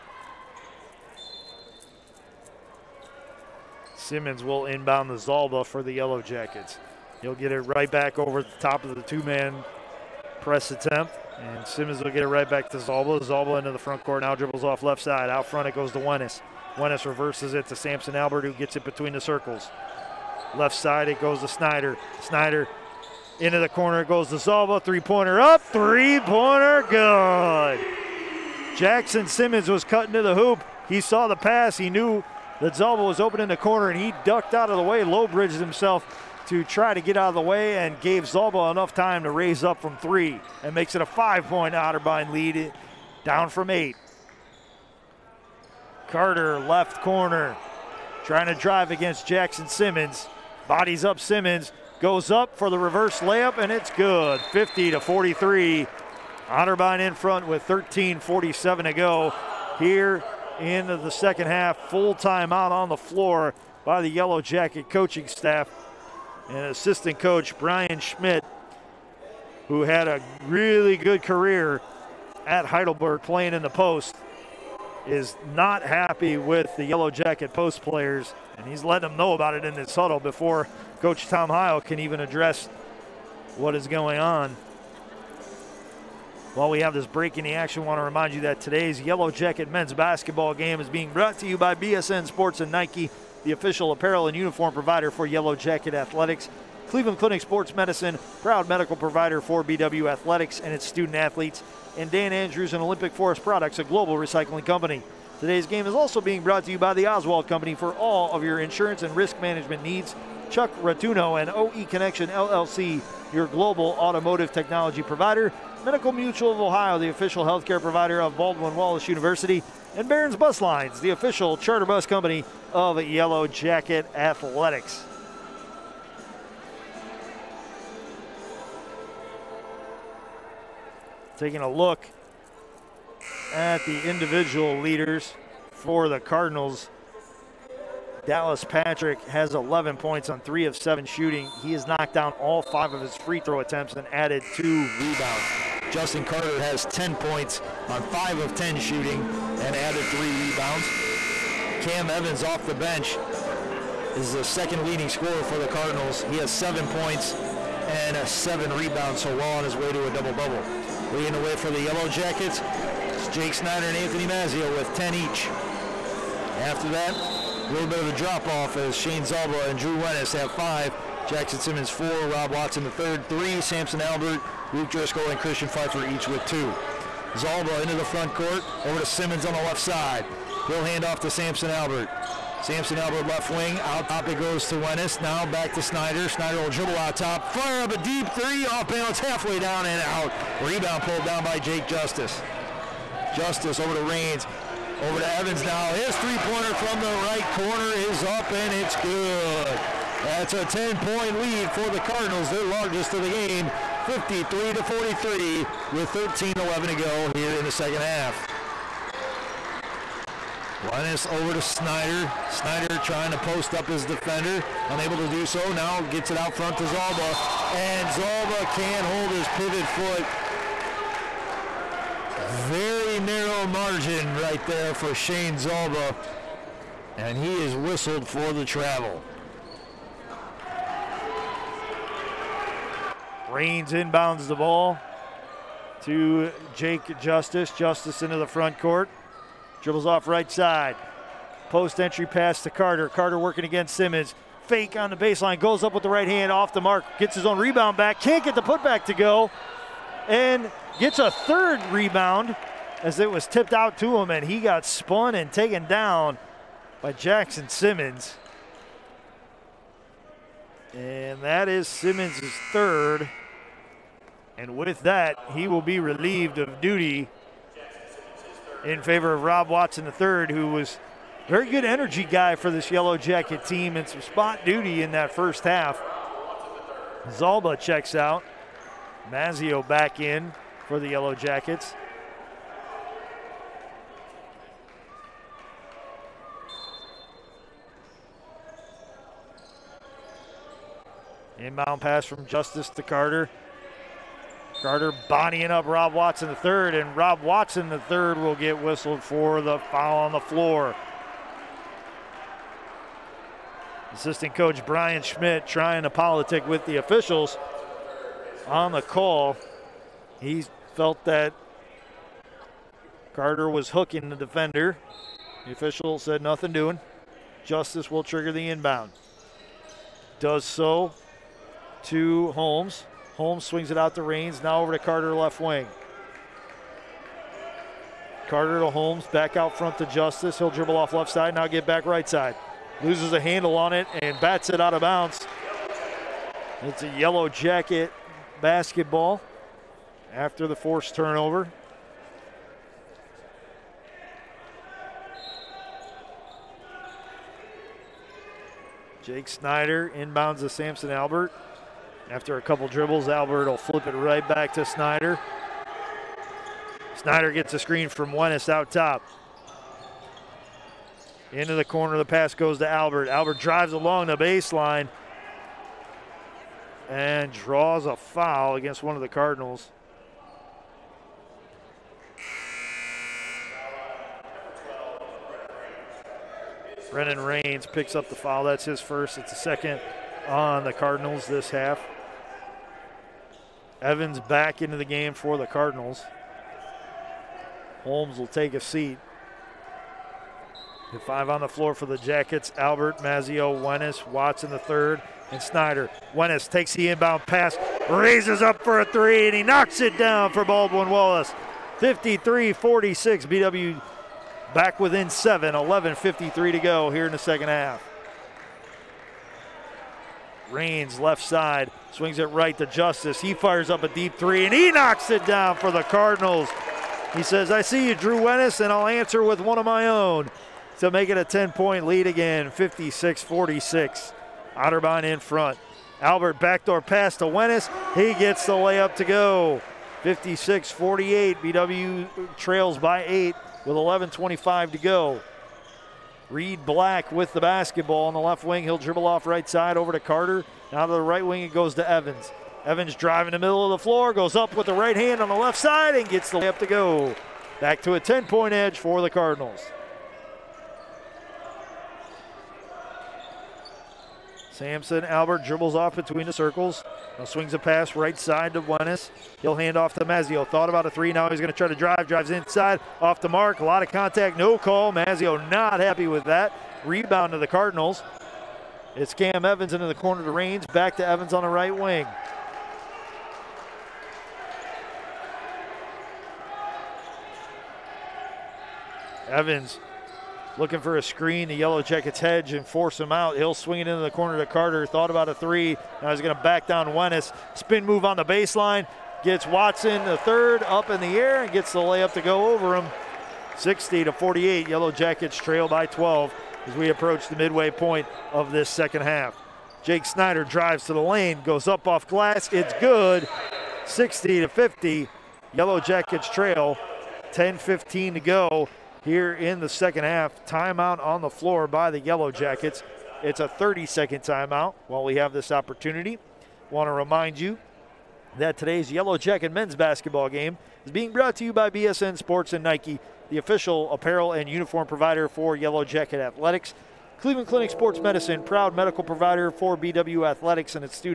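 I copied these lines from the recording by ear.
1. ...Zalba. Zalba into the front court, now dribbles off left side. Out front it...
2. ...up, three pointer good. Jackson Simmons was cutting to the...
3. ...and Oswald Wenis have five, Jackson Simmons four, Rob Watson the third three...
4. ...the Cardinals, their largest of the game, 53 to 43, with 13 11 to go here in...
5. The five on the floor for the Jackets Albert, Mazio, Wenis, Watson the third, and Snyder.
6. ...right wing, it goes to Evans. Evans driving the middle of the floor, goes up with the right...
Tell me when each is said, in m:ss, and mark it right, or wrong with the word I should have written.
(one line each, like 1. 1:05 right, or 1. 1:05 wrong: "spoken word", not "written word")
1. 0:12 right
2. 0:25 right
3. 2:49 wrong: "Drew", not "Oswald"
4. 3:21 right
5. 6:31 right
6. 7:21 right.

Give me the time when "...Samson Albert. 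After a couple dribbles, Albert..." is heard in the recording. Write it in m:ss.
5:50.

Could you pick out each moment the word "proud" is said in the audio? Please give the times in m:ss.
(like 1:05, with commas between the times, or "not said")
1:38, 8:48.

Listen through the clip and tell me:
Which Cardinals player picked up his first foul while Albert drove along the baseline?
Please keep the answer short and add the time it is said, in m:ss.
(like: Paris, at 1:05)
Brennan Rains, at 6:17.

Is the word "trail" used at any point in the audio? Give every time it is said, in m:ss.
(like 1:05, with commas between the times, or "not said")
7:12, 8:15, 8:26.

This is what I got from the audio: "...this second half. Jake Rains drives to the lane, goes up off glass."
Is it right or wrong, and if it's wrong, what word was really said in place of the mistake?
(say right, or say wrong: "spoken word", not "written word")
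wrong: "Snyder", not "Rains".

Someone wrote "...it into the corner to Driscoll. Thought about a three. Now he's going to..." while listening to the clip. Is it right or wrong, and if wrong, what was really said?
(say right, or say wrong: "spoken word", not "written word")
wrong: "Carter", not "Driscoll".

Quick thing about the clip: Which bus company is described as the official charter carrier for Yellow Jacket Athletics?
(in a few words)
Barons Bus Lines.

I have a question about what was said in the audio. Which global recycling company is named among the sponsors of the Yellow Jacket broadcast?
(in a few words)
Olympic Forest Products.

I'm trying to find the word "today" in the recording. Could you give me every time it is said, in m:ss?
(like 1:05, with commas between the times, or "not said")
1:28, 1:45, 8:38.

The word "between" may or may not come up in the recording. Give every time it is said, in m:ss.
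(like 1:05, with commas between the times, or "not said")
0:18, 7:36.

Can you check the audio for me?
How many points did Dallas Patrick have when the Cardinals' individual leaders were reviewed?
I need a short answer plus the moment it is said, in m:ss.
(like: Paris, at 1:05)
11, at 2:19.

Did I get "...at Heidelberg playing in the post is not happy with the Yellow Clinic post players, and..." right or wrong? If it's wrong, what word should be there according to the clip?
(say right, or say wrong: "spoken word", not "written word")
wrong: "Jacket", not "Clinic".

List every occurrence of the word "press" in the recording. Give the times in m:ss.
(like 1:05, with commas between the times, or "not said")
0:10.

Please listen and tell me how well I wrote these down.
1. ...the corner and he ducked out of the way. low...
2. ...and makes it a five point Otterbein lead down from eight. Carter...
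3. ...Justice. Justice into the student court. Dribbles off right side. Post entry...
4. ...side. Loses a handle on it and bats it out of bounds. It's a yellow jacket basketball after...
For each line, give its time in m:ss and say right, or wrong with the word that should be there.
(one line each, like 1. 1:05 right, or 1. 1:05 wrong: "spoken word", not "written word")
1. 0:33 right
2. 0:40 right
3. 3:57 wrong: "front", not "student"
4. 5:32 right.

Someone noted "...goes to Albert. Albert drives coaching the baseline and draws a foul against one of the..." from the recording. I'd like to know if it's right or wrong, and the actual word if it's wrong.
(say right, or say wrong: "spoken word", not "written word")
wrong: "along", not "coaching".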